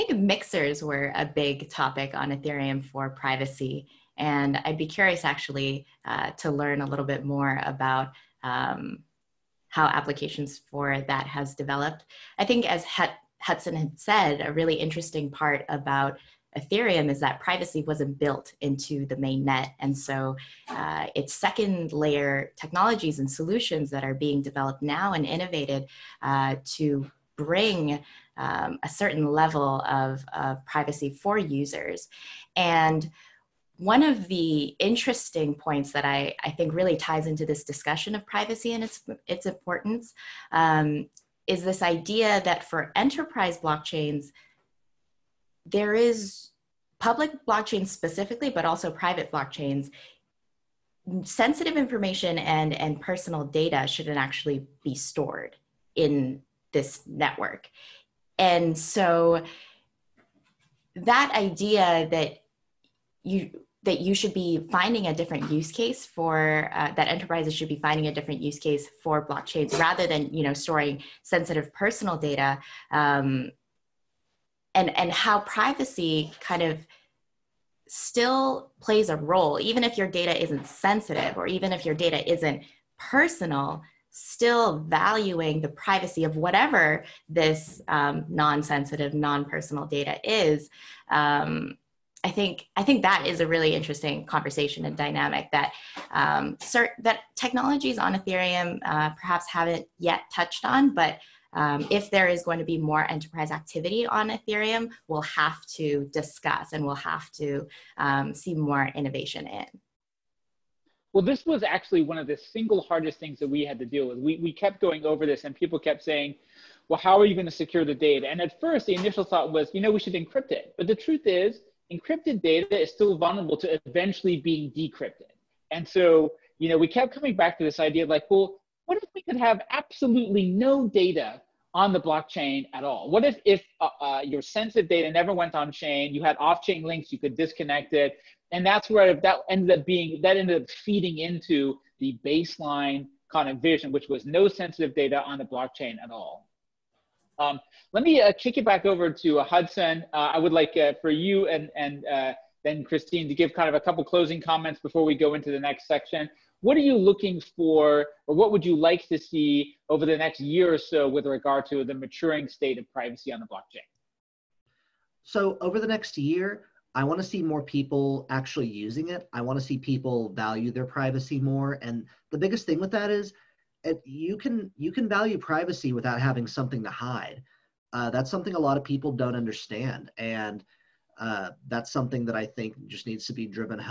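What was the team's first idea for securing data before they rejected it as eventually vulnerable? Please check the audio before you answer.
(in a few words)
Encrypt it.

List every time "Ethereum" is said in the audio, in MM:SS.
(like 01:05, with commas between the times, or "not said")
00:02, 00:16, 01:38, 01:44.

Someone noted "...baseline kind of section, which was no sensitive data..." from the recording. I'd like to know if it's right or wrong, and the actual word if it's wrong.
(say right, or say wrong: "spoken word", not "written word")
wrong: "vision", not "section".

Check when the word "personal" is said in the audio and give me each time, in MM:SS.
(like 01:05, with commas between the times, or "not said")
00:53, 01:11, 01:22, 01:29.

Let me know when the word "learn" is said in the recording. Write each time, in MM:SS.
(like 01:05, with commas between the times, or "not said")
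00:06.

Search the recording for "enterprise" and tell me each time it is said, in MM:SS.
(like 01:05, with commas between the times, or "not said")
00:42, 01:07, 01:43.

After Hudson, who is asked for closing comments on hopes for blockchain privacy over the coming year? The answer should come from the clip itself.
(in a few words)
Christine.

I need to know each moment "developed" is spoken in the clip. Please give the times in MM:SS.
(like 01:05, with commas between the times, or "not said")
00:11, 00:24.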